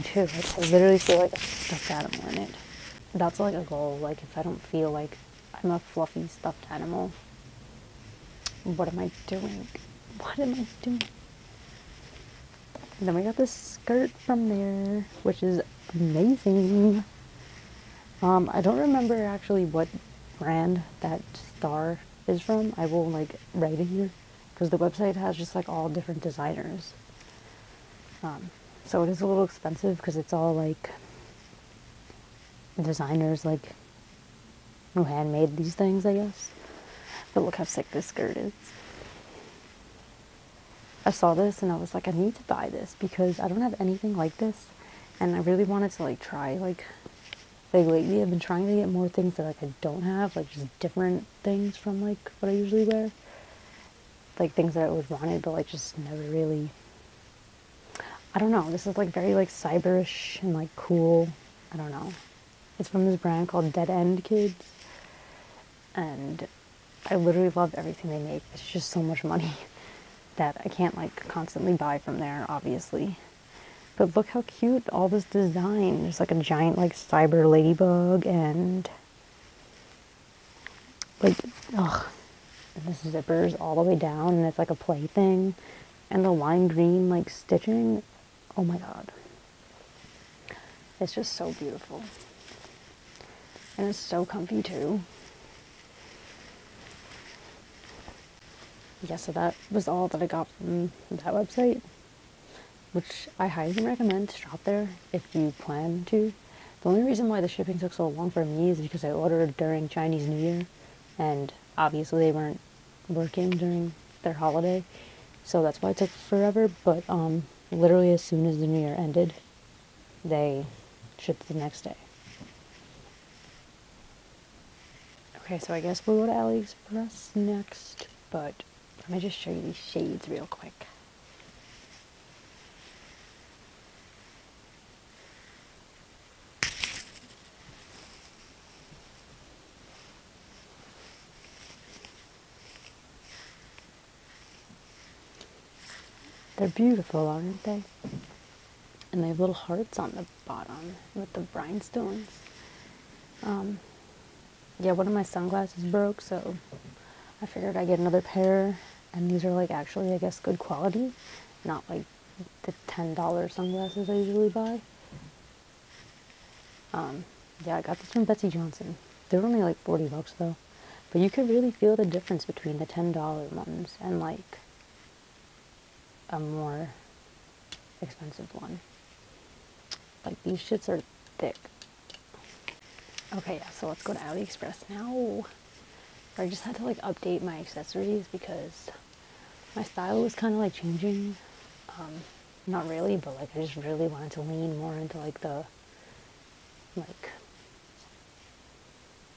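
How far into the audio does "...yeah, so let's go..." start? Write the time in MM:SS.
03:03.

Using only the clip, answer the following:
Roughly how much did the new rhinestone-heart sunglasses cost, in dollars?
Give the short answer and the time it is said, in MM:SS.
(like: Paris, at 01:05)
$40, at 02:49.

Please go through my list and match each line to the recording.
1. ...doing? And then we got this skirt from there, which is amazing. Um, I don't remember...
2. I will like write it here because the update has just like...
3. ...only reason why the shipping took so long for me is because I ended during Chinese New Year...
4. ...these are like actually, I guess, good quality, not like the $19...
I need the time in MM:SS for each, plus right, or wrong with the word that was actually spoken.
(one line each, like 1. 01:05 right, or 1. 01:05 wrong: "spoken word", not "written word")
1. 00:10 right
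2. 00:22 wrong: "website", not "update"
3. 01:46 wrong: "ordered", not "ended"
4. 02:39 wrong: "10", not "19".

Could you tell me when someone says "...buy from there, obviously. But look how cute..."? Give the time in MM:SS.
01:11.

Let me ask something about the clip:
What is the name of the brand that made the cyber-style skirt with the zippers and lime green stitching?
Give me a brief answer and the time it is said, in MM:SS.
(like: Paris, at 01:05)
Dead End Kids, at 01:03.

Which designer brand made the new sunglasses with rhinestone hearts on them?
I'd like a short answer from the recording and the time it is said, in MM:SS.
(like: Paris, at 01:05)
Betsey Johnson, at 02:48.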